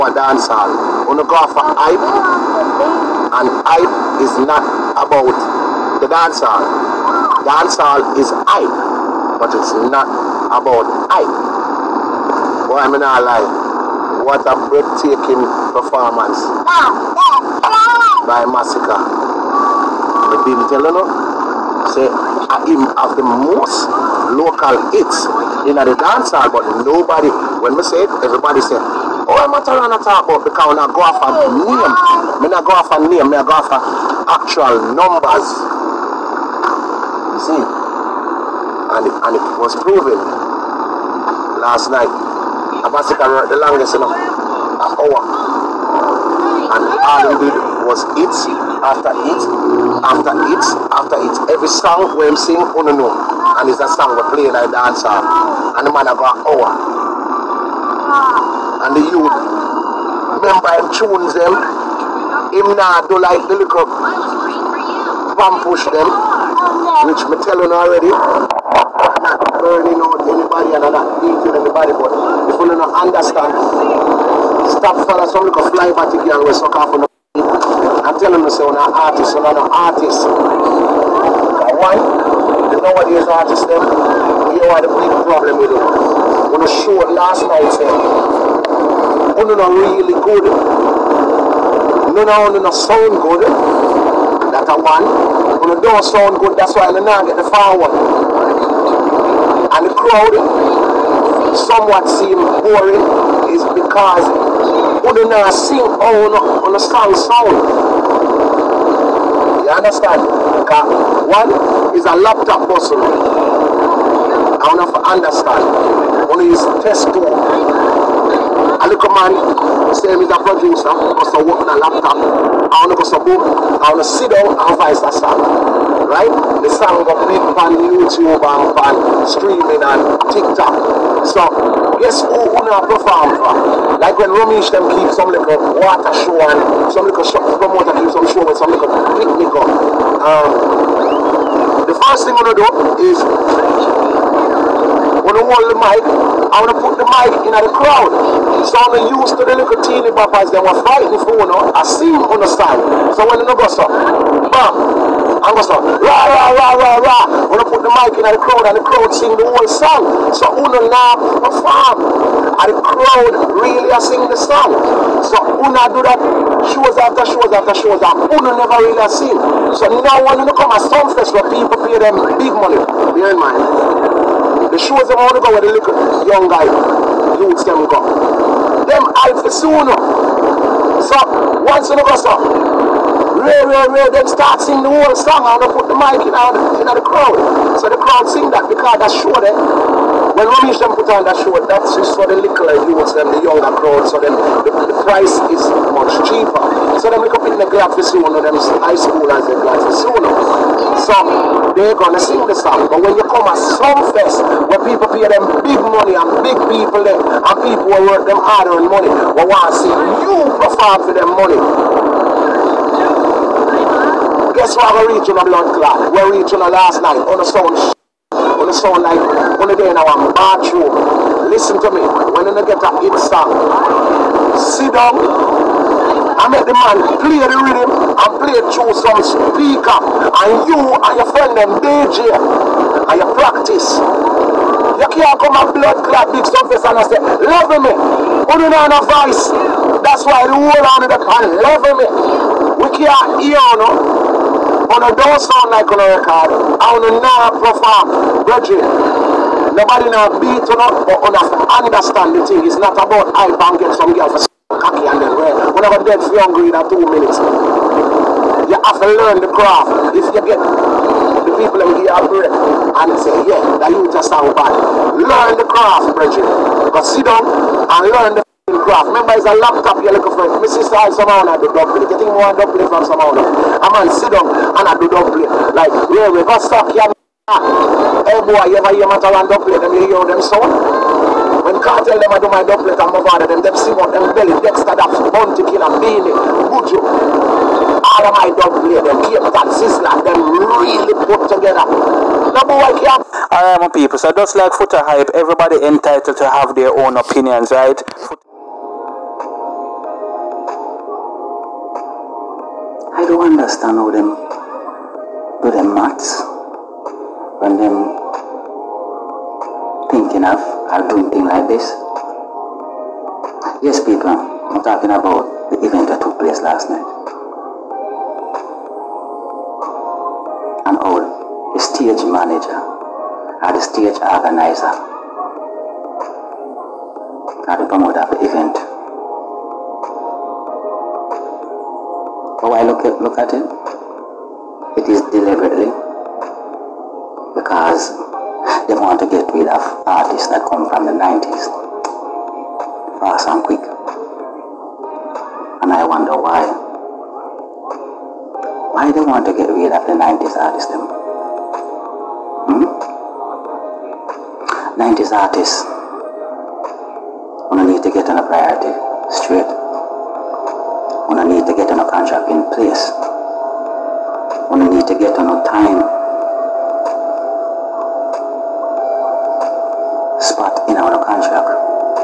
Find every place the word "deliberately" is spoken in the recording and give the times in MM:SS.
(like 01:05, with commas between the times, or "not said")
05:35.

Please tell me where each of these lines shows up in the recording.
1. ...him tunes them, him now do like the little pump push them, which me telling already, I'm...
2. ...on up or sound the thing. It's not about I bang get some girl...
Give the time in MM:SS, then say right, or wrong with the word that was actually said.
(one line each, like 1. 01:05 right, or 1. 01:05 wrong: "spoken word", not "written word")
1. 01:00 right
2. 04:10 wrong: "understand", not "sound".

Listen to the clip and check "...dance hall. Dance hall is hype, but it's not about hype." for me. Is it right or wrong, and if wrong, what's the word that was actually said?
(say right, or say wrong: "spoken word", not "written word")
right.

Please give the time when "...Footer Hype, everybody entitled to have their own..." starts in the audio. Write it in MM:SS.
04:54.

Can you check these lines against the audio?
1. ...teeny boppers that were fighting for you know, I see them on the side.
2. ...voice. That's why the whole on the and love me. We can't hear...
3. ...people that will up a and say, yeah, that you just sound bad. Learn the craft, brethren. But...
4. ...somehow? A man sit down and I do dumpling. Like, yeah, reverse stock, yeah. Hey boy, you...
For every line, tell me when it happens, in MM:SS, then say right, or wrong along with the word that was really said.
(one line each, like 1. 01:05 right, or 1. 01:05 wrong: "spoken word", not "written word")
1. 02:29 right
2. 03:59 right
3. 04:21 right
4. 04:33 right.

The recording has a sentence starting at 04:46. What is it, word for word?
All of my doublet, them Cape Town, Sizzler, them really put together.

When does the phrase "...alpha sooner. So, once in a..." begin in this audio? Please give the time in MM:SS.
02:59.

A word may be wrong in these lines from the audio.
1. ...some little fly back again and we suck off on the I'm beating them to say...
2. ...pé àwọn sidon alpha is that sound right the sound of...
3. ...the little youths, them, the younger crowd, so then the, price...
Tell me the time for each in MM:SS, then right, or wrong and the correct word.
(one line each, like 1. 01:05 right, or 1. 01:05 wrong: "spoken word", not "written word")
1. 01:15 wrong: "telling", not "beating"
2. 02:03 right
3. 03:12 right.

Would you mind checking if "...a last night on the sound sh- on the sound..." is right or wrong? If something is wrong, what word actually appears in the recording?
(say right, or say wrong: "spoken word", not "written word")
right.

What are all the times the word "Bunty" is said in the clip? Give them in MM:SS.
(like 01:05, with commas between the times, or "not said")
04:45.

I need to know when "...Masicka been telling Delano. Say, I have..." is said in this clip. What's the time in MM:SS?
00:18.